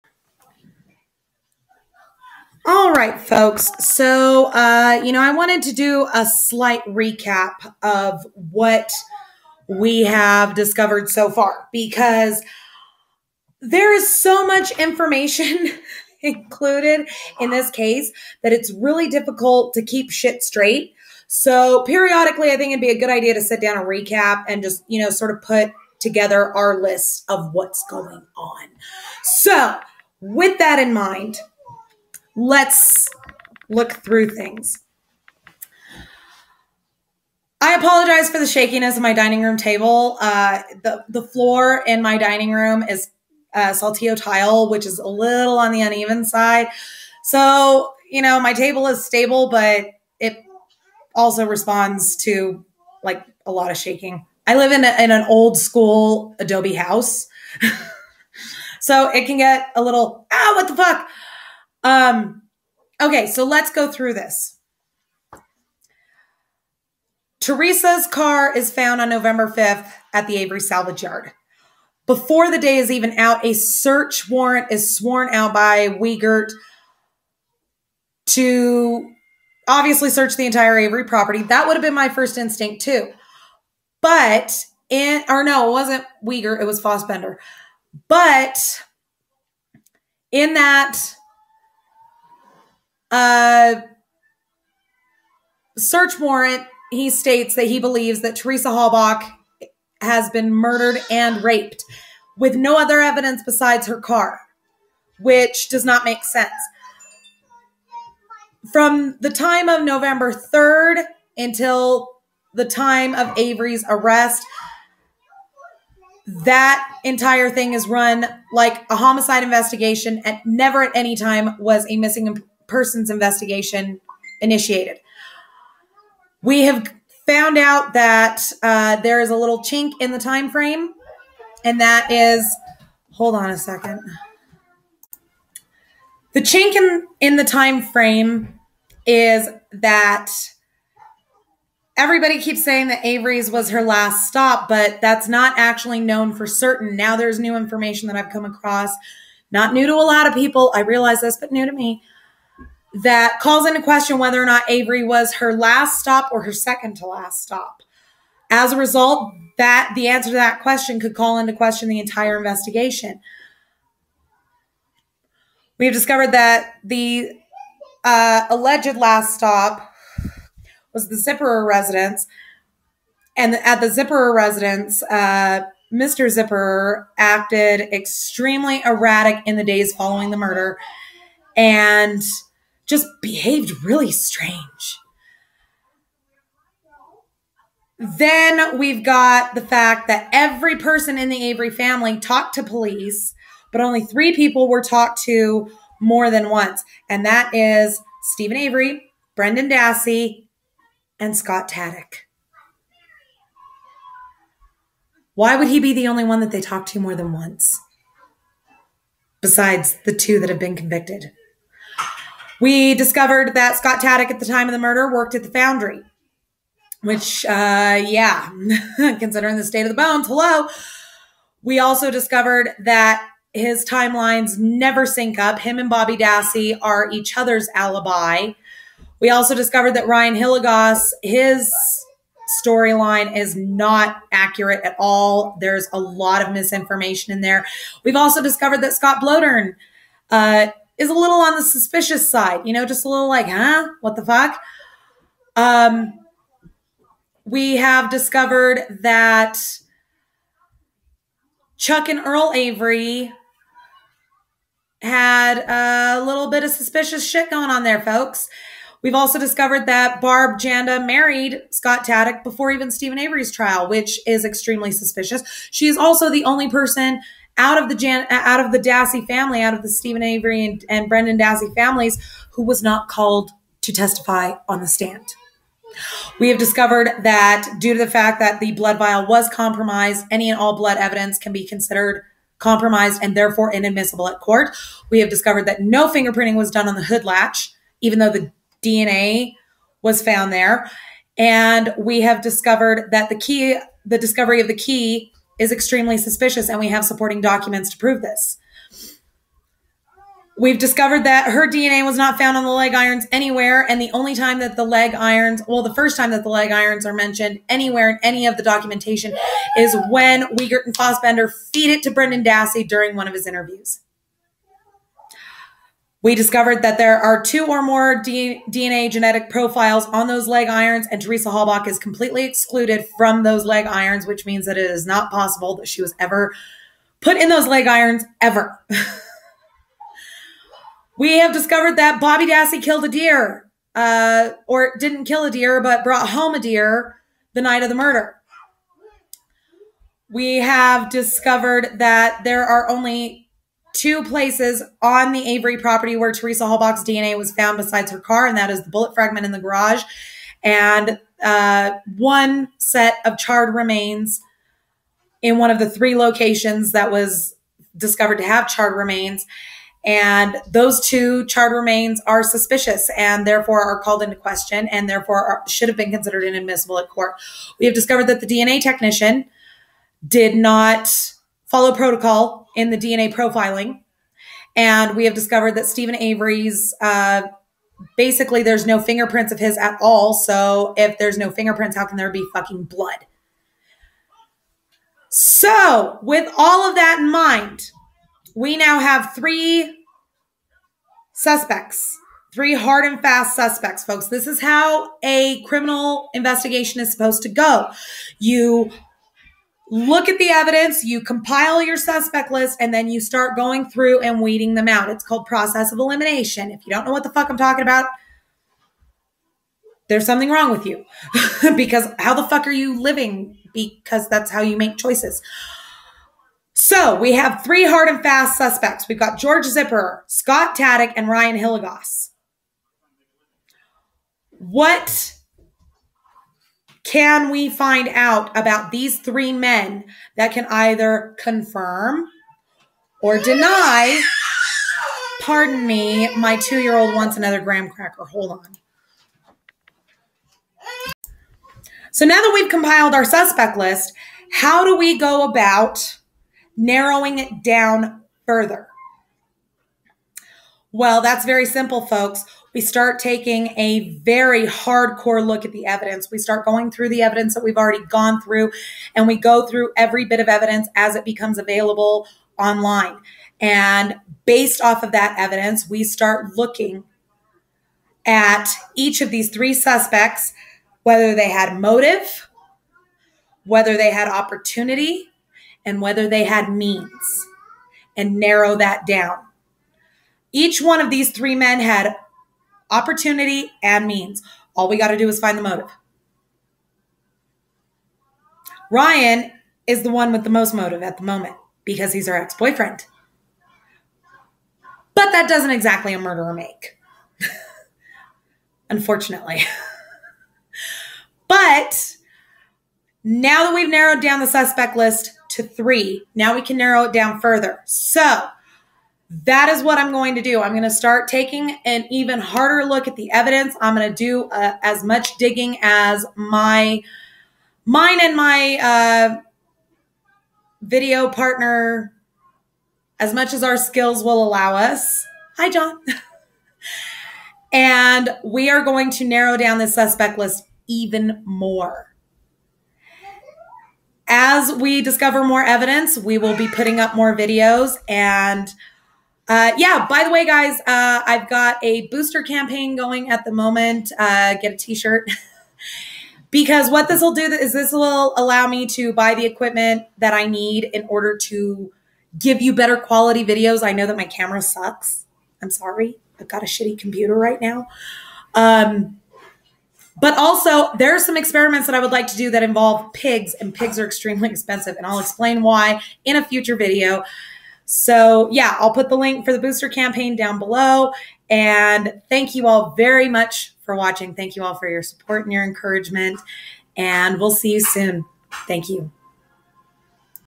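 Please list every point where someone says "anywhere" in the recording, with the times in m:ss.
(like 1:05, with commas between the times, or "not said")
5:03, 5:07.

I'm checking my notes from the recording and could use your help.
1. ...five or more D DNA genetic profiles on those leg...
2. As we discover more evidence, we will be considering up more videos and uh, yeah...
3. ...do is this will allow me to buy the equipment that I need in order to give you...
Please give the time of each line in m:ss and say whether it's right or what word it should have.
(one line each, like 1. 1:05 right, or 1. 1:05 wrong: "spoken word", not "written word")
1. 5:17 wrong: "two", not "five"
2. 8:54 wrong: "putting", not "considering"
3. 9:07 right.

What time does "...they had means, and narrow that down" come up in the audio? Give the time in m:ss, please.
7:56.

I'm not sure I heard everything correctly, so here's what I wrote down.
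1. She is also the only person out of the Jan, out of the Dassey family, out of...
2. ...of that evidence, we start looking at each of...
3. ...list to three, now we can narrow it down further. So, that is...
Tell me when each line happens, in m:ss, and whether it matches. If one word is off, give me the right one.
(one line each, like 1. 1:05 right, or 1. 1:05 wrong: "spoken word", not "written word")
1. 4:25 right
2. 7:45 right
3. 8:24 right.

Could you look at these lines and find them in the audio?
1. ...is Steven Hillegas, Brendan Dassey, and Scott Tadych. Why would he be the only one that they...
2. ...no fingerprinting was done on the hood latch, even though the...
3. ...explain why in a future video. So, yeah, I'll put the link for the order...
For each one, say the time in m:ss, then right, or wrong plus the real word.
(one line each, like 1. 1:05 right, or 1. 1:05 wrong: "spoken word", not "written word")
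1. 3:17 wrong: "Avery", not "Hillegas"
2. 4:45 right
3. 9:25 wrong: "booster", not "order".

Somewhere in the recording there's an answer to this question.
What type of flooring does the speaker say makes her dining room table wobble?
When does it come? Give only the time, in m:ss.
0:43.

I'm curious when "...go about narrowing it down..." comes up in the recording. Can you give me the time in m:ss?
7:25.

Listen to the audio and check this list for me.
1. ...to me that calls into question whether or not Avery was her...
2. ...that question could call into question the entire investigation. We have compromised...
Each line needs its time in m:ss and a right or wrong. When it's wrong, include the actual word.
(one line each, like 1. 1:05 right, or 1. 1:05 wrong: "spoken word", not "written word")
1. 2:31 right
2. 2:40 wrong: "discovered", not "compromised".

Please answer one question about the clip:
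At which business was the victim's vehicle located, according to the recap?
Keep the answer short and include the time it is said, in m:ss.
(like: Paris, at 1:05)
Avery Salvage Yard, at 1:10.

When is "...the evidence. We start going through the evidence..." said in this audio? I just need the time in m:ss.
7:35.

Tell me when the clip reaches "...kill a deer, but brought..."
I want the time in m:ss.
5:35.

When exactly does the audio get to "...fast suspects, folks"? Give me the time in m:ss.
6:33.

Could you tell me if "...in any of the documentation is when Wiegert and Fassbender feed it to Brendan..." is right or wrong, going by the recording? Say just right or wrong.
right.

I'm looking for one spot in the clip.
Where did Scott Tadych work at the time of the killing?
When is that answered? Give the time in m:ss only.
3:35.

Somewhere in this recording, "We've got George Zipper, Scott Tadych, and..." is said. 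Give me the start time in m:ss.
6:59.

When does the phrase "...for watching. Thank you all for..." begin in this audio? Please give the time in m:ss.
9:33.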